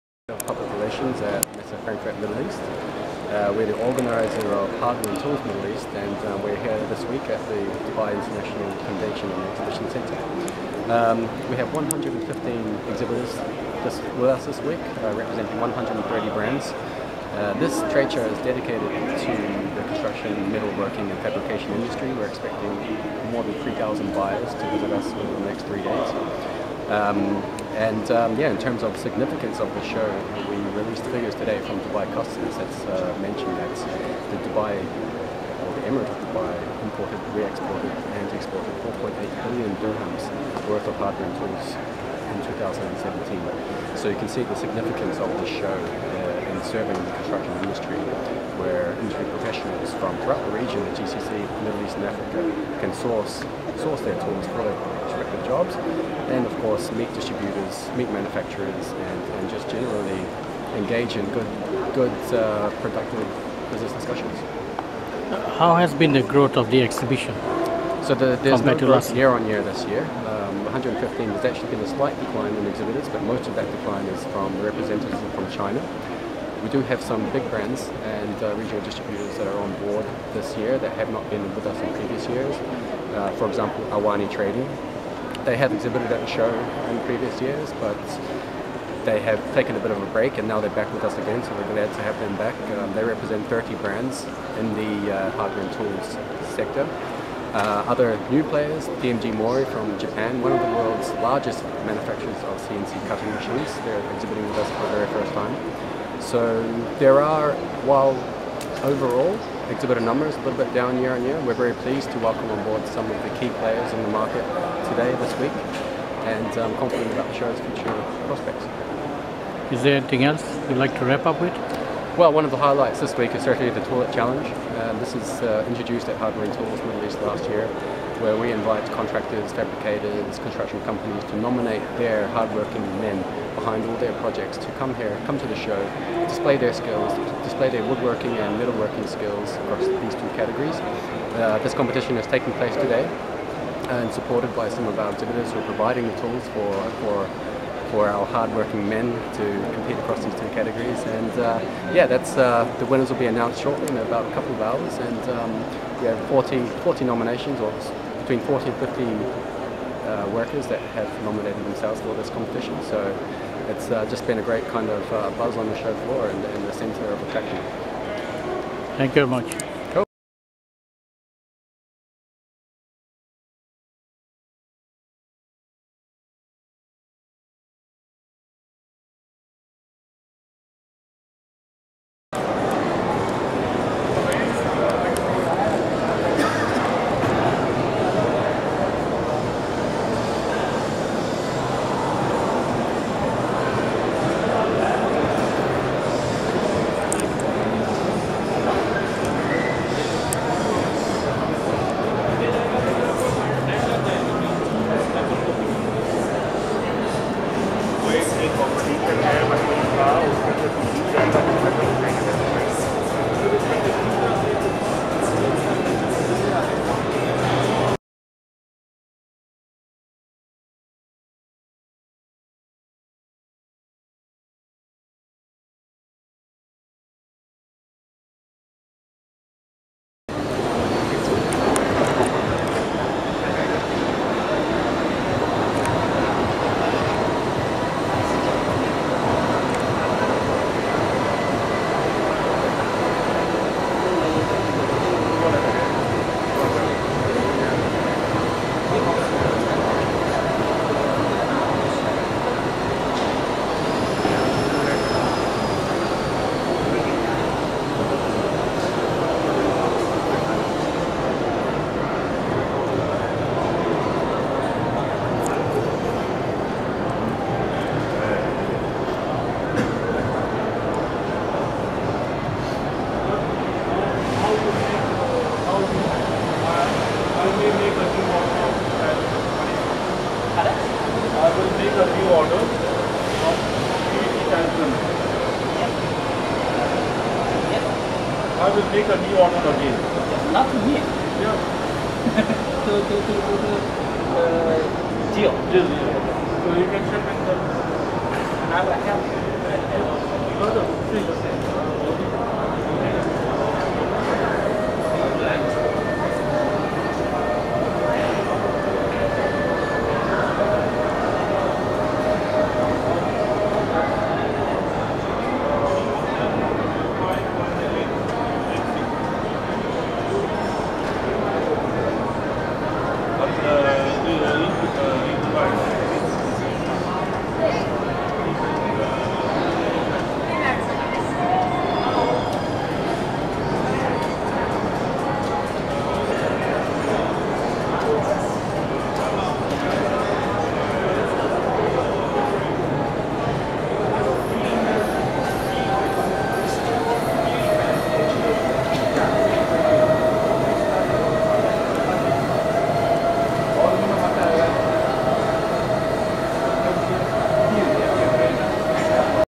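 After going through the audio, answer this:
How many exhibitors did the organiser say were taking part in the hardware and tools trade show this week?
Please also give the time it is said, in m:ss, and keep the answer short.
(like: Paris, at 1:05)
115, at 0:11.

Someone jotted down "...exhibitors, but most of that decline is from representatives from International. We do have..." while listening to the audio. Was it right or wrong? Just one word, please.
wrong.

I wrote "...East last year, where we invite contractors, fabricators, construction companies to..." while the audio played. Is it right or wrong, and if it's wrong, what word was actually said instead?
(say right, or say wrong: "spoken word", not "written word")
right.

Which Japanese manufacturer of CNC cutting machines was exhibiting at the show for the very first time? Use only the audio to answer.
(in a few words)
DMG Mori.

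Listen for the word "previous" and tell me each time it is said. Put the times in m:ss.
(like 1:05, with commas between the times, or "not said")
1:21, 1:27.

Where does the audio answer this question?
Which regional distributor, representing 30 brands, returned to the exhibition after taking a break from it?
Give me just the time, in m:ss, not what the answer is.
1:23.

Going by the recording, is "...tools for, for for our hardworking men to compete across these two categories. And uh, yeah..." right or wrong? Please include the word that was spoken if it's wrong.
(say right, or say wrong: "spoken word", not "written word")
right.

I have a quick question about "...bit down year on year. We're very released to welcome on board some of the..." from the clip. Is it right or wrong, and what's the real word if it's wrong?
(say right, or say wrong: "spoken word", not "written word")
wrong: "pleased", not "released".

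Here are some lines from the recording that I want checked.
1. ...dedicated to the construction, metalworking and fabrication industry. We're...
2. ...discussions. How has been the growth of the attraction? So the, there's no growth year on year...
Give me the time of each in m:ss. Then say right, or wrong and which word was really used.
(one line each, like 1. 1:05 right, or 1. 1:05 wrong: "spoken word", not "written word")
1. 0:18 right
2. 1:03 wrong: "exhibition", not "attraction".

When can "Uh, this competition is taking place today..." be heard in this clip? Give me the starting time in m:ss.
2:21.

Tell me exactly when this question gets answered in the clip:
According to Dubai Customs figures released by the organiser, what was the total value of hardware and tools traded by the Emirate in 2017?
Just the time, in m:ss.
0:38.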